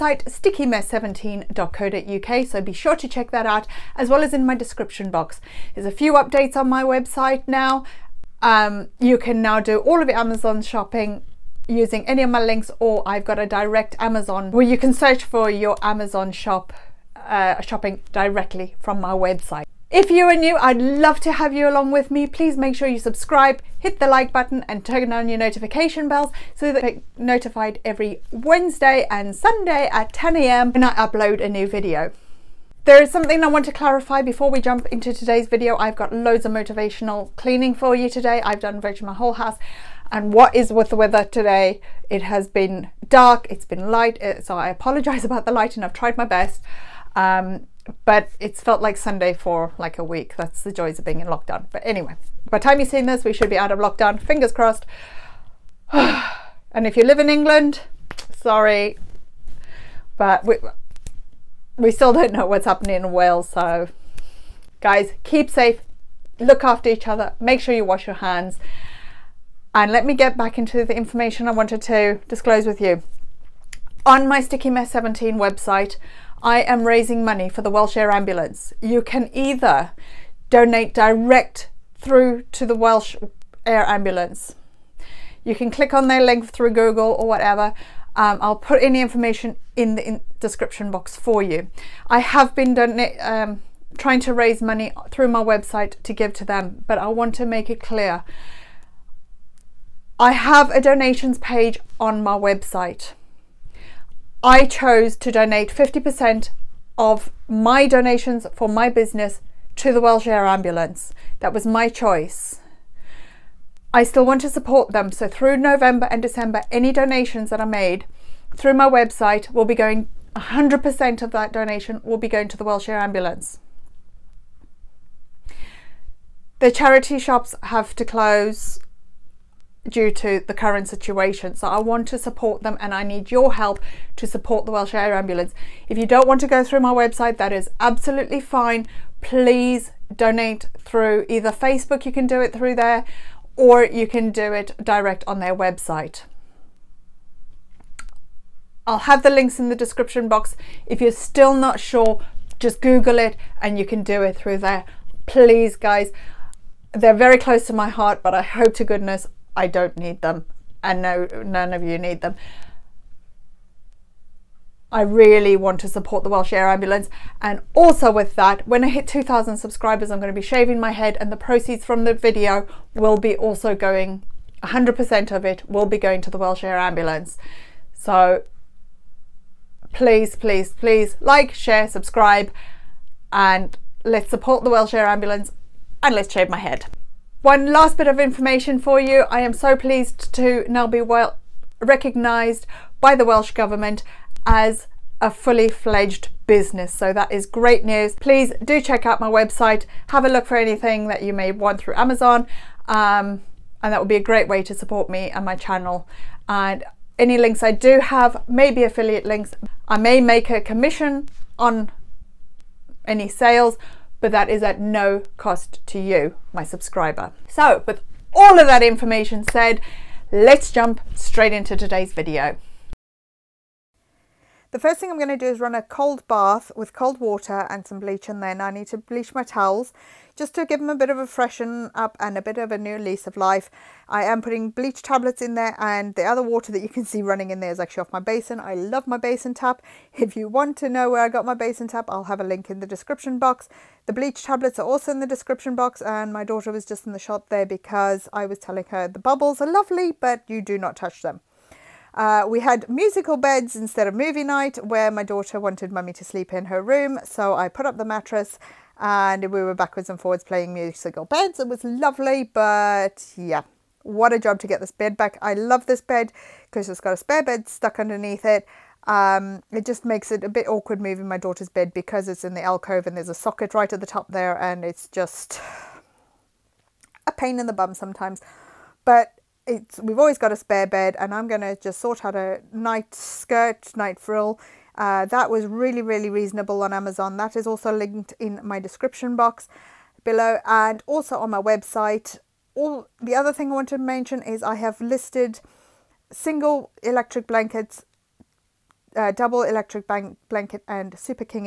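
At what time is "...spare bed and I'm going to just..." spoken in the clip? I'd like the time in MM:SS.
04:40.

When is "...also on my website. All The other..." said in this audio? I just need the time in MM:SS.
04:51.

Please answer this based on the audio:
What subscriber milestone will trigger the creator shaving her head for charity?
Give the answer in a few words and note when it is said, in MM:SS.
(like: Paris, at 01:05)
2,000, at 02:49.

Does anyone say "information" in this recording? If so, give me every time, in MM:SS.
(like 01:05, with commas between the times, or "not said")
01:10, 01:29, 03:08, 03:38.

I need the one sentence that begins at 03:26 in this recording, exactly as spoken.
And any links I do have may be affiliate links.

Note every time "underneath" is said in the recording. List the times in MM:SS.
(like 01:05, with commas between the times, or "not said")
04:27.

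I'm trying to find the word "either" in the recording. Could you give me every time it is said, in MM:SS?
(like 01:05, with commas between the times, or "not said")
01:19, 02:21.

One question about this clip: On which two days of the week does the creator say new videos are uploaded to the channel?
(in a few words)
Wednesday and Sunday.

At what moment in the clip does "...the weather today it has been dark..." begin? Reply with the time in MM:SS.
00:40.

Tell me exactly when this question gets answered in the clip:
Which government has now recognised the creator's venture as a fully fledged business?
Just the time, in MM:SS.
03:13.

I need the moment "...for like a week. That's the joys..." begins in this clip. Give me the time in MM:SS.
00:49.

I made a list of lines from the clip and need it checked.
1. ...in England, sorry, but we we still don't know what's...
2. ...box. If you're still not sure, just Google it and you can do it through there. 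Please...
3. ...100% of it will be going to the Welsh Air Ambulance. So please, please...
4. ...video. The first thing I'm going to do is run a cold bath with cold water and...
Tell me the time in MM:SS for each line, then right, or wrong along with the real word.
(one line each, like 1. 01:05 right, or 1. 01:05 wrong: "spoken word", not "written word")
1. 00:57 right
2. 02:30 right
3. 02:54 right
4. 03:42 right.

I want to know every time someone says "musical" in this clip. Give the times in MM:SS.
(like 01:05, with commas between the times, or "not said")
04:12, 04:20.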